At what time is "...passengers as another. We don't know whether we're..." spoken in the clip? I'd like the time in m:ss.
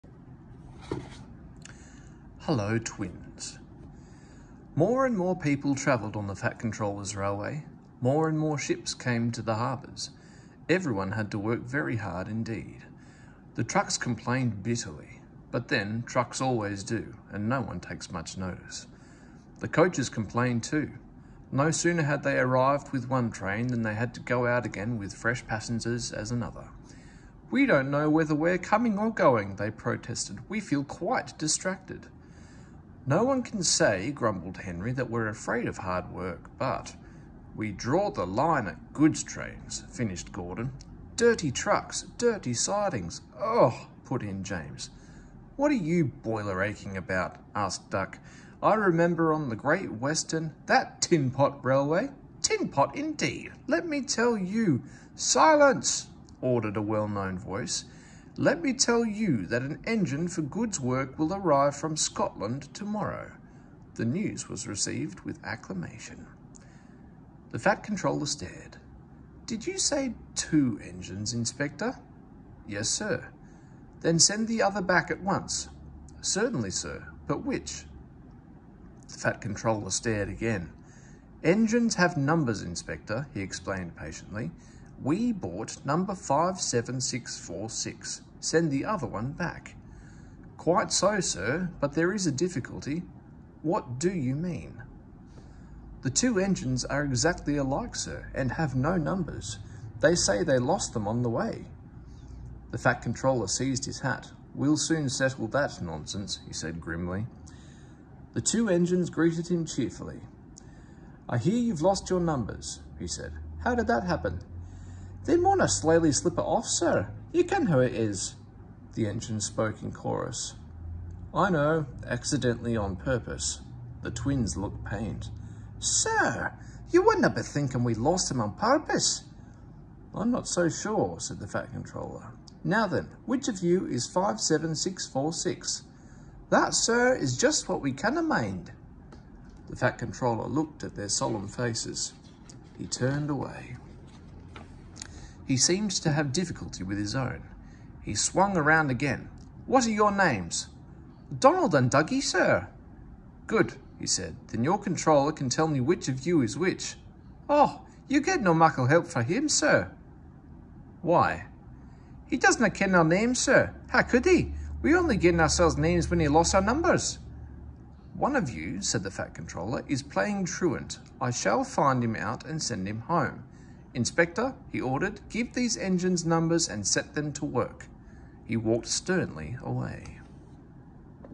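0:25.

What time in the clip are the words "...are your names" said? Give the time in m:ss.
2:29.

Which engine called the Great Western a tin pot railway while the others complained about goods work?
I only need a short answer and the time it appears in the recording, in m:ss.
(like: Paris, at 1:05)
Duck, at 0:47.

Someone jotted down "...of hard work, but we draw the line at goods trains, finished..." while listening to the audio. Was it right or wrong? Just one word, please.
right.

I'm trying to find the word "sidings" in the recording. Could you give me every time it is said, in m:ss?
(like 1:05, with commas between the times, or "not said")
0:42.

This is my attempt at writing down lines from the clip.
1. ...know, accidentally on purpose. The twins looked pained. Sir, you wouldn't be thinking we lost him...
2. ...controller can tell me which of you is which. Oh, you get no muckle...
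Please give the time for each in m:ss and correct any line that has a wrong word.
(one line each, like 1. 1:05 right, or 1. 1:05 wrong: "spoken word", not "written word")
1. 2:01 right
2. 2:34 right.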